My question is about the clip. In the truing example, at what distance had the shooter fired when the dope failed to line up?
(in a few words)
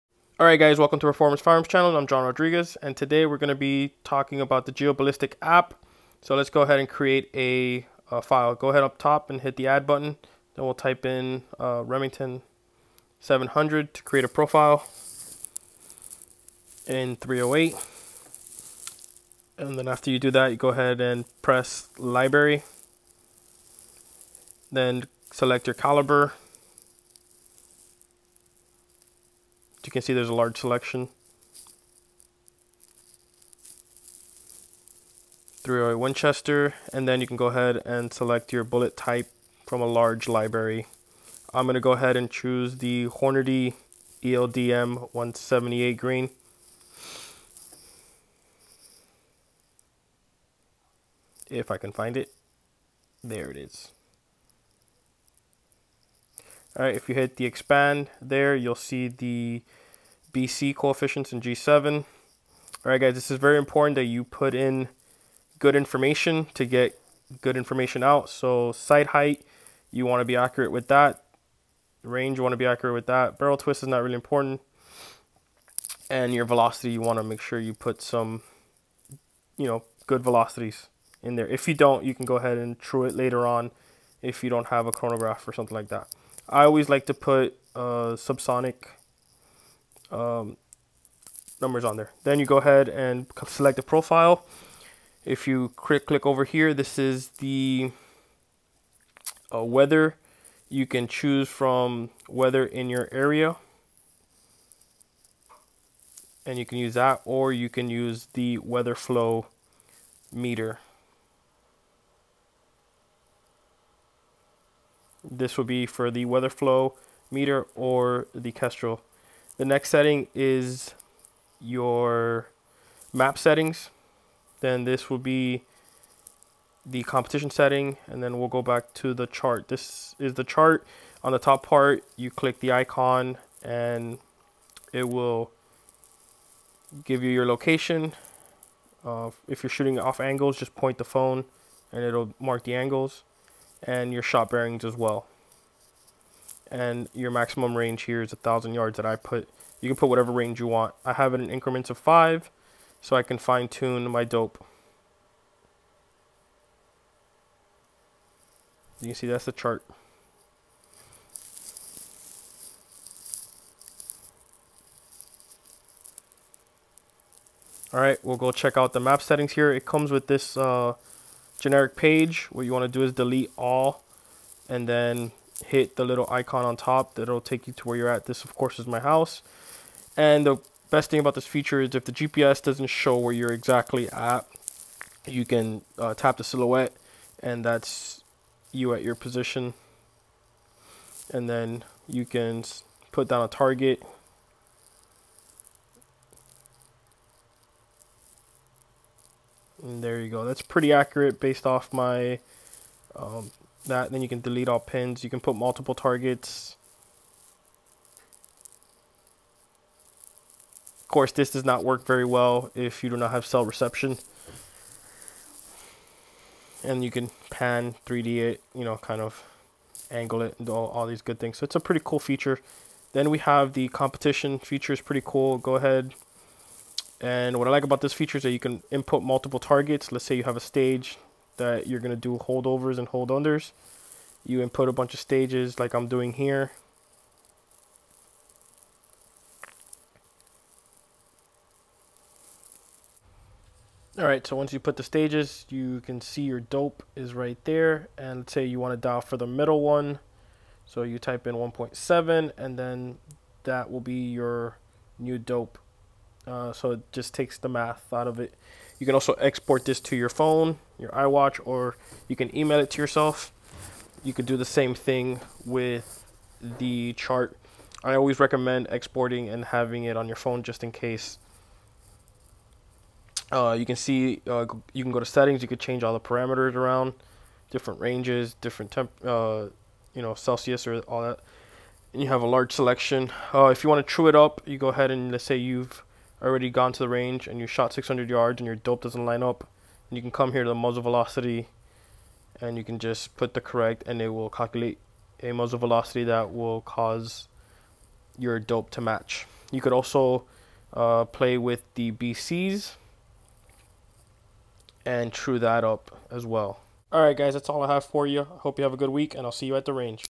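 600 yards.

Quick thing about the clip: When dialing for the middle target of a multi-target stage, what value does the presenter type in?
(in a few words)
1.7.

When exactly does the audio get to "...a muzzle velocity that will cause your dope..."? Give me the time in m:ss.
4:55.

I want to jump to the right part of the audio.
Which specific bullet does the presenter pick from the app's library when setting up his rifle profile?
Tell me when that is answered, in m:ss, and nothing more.
0:43.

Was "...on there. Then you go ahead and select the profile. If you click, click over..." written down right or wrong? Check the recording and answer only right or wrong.
right.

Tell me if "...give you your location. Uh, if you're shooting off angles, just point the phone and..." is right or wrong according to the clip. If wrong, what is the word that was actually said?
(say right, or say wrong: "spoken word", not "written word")
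right.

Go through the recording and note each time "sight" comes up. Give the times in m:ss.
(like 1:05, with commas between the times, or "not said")
1:08.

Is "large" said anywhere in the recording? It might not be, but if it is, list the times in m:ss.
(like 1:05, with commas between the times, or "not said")
0:30, 0:39, 4:42.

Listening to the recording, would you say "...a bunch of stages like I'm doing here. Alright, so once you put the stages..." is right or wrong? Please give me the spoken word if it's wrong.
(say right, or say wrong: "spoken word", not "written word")
right.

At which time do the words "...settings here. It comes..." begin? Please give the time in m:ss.
2:49.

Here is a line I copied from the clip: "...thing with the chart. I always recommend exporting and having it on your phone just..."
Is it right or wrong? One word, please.
right.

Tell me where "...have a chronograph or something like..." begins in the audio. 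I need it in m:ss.
1:24.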